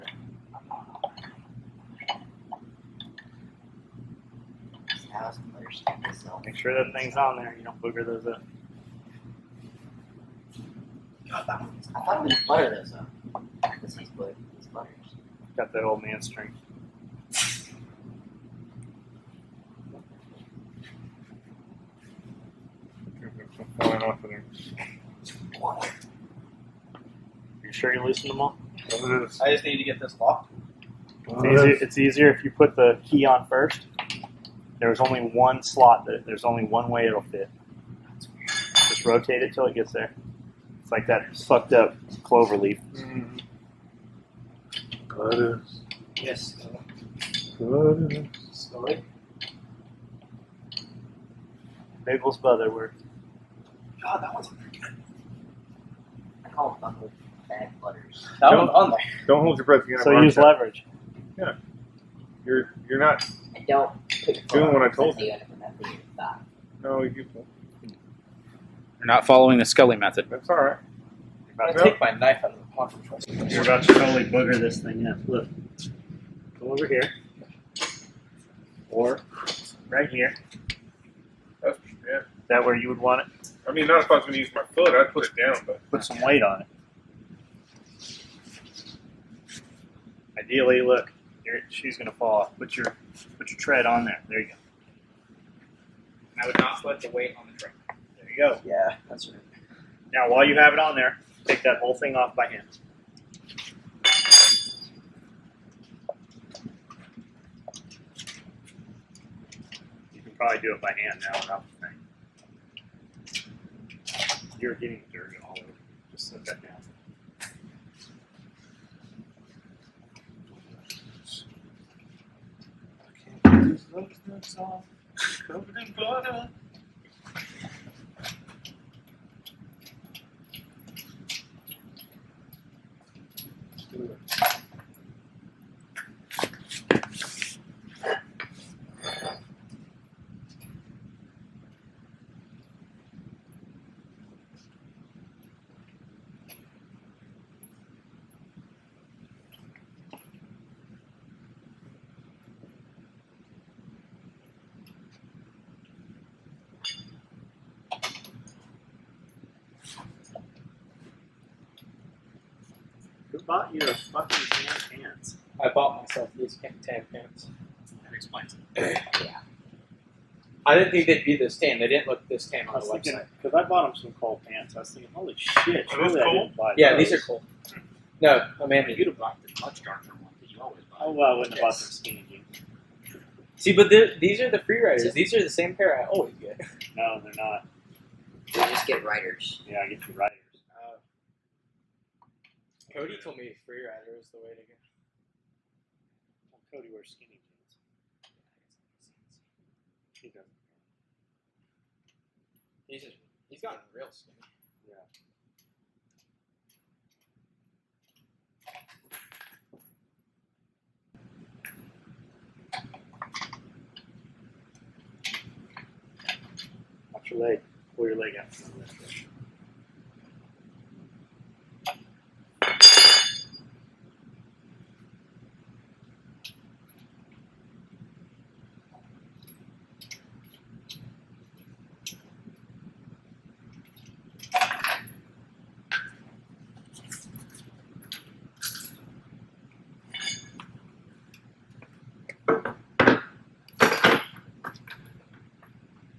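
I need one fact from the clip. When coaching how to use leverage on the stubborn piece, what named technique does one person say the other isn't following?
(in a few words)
the Scully method.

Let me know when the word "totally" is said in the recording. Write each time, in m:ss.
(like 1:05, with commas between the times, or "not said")
1:13.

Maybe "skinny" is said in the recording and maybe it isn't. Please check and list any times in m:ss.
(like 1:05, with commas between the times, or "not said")
3:01, 3:17, 3:24.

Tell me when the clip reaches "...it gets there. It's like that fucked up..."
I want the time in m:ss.
0:39.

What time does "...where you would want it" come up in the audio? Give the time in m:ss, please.
1:22.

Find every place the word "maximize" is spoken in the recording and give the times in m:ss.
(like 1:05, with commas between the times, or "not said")
not said.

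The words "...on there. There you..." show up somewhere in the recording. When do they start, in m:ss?
1:33.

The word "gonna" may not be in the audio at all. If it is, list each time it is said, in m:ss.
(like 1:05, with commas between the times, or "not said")
1:11, 1:31.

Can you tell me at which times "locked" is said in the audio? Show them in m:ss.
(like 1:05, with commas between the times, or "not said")
0:30.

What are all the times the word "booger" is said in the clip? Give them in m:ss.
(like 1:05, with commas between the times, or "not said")
0:07, 1:14.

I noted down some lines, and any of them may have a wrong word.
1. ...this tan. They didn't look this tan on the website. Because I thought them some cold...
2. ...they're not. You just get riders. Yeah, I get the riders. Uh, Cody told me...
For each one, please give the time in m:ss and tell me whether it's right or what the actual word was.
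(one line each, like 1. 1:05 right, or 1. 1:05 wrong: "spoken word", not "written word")
1. 2:51 wrong: "bought", not "thought"
2. 3:07 right.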